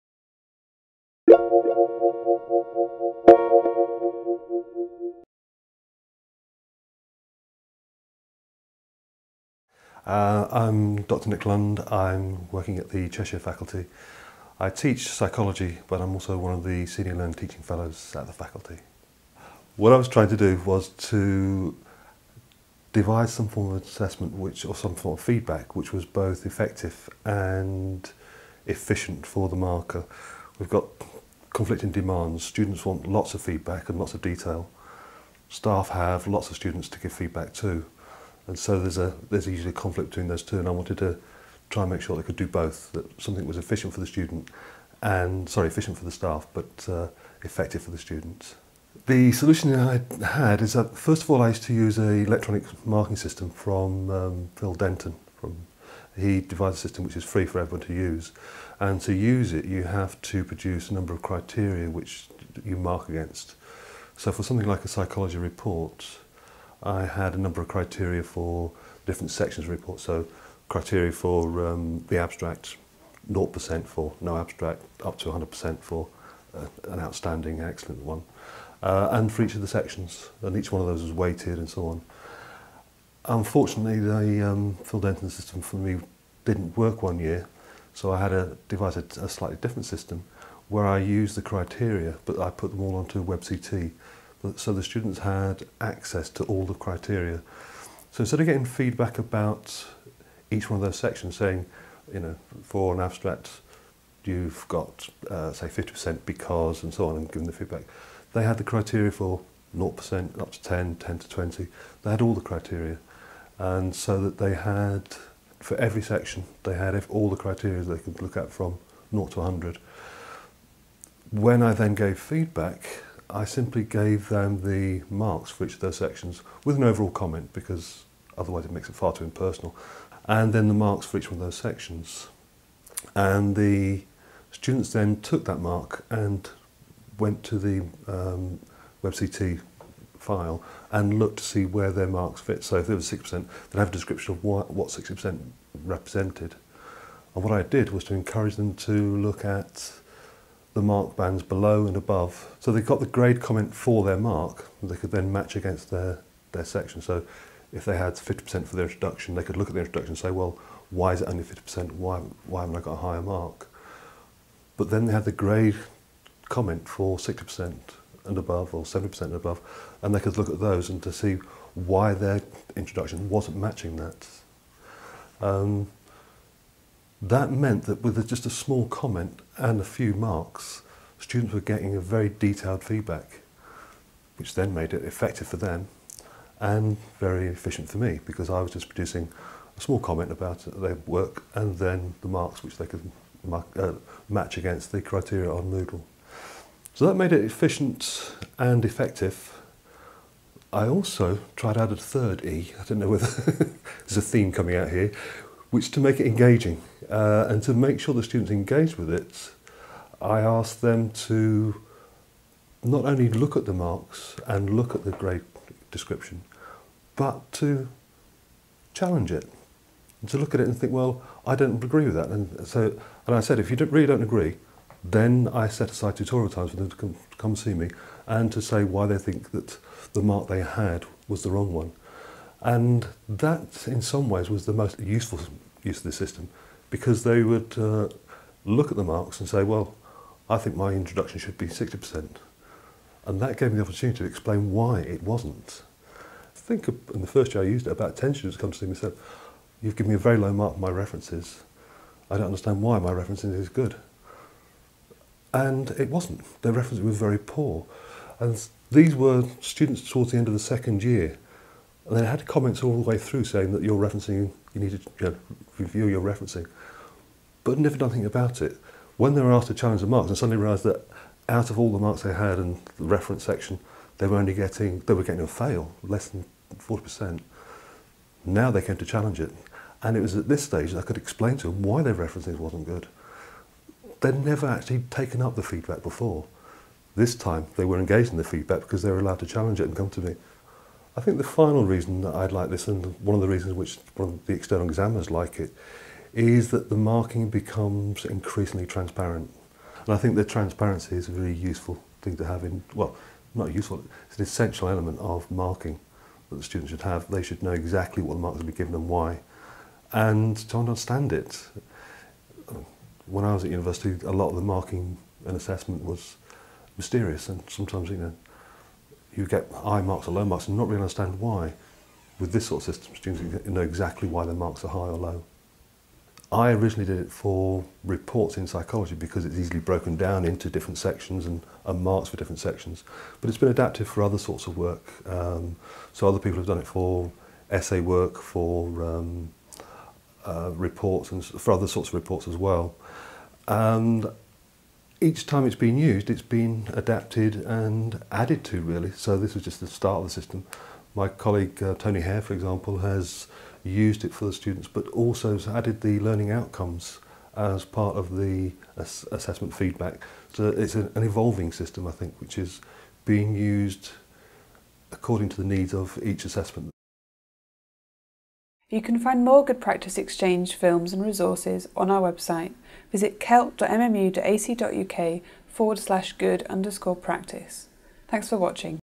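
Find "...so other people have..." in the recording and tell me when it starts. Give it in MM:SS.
05:36.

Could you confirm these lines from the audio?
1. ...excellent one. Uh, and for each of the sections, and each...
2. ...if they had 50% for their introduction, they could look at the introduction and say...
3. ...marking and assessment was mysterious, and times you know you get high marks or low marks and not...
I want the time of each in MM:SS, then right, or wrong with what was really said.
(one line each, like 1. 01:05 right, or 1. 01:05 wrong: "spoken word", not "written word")
1. 01:17 right
2. 02:37 right
3. 05:14 wrong: "sometimes", not "times".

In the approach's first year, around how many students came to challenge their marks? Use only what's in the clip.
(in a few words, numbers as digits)
10.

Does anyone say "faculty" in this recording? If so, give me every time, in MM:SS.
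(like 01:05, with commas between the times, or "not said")
00:13, 00:18.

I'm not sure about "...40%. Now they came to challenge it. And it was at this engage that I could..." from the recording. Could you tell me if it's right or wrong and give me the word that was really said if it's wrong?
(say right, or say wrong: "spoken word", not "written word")
wrong: "stage", not "engage".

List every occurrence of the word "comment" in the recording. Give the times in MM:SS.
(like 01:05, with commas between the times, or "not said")
02:07, 02:33, 02:46, 02:58, 03:09, 04:22.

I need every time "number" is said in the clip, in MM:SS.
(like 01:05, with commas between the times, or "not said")
01:00, 01:07.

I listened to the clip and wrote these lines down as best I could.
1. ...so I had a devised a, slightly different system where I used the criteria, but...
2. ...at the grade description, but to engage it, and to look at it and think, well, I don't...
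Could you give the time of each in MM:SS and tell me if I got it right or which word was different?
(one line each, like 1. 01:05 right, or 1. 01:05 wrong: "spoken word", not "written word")
1. 01:27 right
2. 03:34 wrong: "challenge", not "engage".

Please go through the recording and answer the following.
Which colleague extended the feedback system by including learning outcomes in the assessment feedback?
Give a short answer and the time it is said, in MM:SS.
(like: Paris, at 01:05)
Tony Hare, at 05:51.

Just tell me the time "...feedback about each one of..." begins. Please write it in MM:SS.
01:38.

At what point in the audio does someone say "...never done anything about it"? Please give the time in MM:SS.
04:27.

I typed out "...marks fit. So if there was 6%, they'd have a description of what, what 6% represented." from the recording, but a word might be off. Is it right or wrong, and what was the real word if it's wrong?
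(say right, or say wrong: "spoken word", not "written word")
right.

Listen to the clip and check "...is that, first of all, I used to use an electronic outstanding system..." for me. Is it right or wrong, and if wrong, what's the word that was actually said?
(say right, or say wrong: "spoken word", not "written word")
wrong: "marking", not "outstanding".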